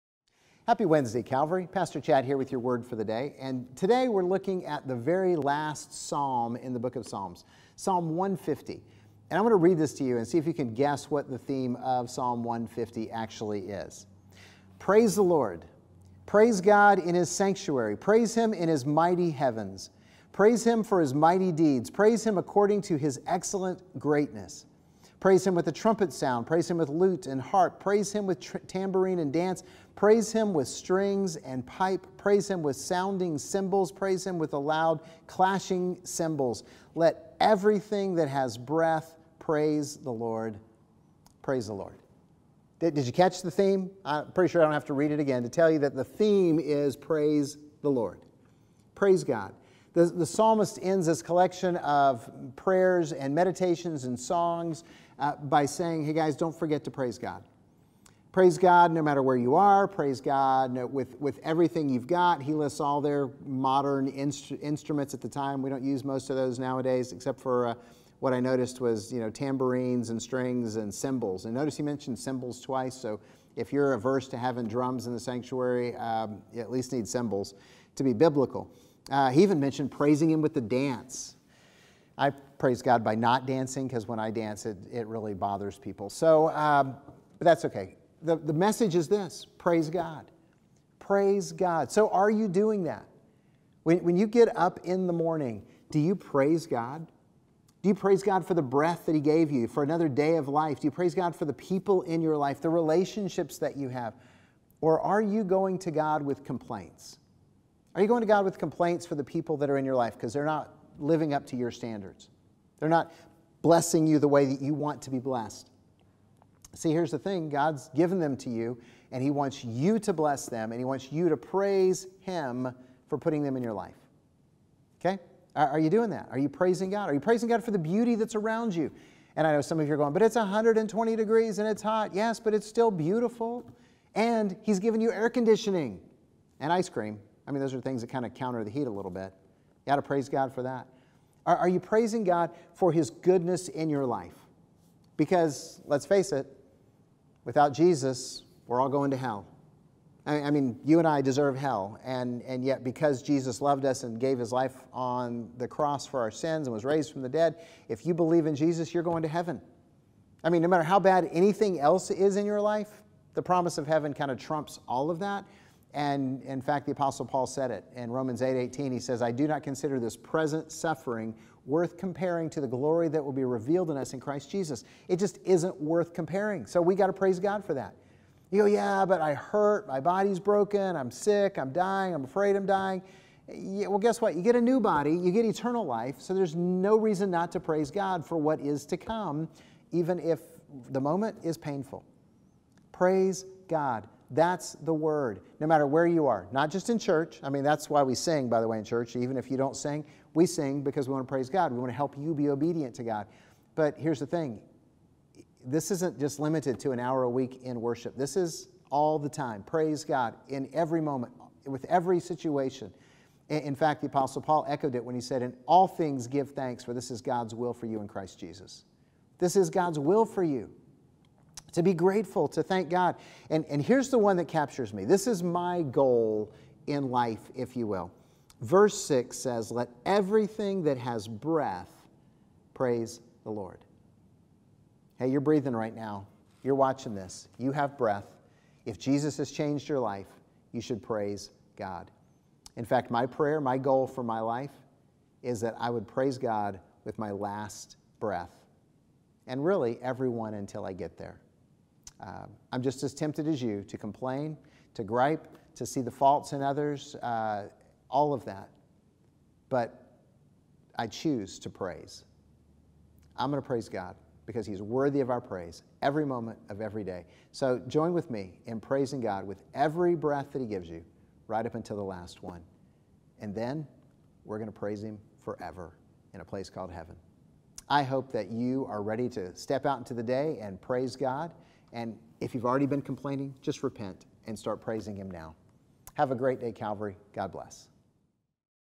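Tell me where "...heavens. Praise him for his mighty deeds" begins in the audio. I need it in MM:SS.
00:19.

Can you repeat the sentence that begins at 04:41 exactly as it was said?
And if you've already been complaining, just repent and start praising Him now.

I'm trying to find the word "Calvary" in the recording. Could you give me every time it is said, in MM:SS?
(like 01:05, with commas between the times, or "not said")
00:01, 04:46.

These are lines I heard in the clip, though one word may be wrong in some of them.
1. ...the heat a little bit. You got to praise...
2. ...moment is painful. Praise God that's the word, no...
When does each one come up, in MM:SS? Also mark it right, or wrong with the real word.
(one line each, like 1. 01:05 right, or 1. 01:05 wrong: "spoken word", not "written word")
1. 02:18 right
2. 03:10 right.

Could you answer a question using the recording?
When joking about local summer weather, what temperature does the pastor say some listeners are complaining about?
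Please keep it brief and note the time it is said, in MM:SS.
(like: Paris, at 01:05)
120 degrees, at 02:10.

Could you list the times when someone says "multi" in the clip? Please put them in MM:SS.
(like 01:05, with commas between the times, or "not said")
not said.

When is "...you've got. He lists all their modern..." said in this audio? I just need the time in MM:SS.
01:01.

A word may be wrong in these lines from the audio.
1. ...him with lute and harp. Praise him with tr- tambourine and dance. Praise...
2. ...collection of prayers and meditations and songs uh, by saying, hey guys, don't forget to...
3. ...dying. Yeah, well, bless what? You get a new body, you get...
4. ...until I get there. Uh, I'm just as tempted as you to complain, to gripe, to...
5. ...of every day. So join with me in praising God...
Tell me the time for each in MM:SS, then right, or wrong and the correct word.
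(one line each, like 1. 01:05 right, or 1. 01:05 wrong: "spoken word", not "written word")
1. 00:26 right
2. 00:51 right
3. 03:02 wrong: "guess", not "bless"
4. 04:10 right
5. 04:26 right.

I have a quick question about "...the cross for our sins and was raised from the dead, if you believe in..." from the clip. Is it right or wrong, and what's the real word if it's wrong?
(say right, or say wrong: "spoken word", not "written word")
right.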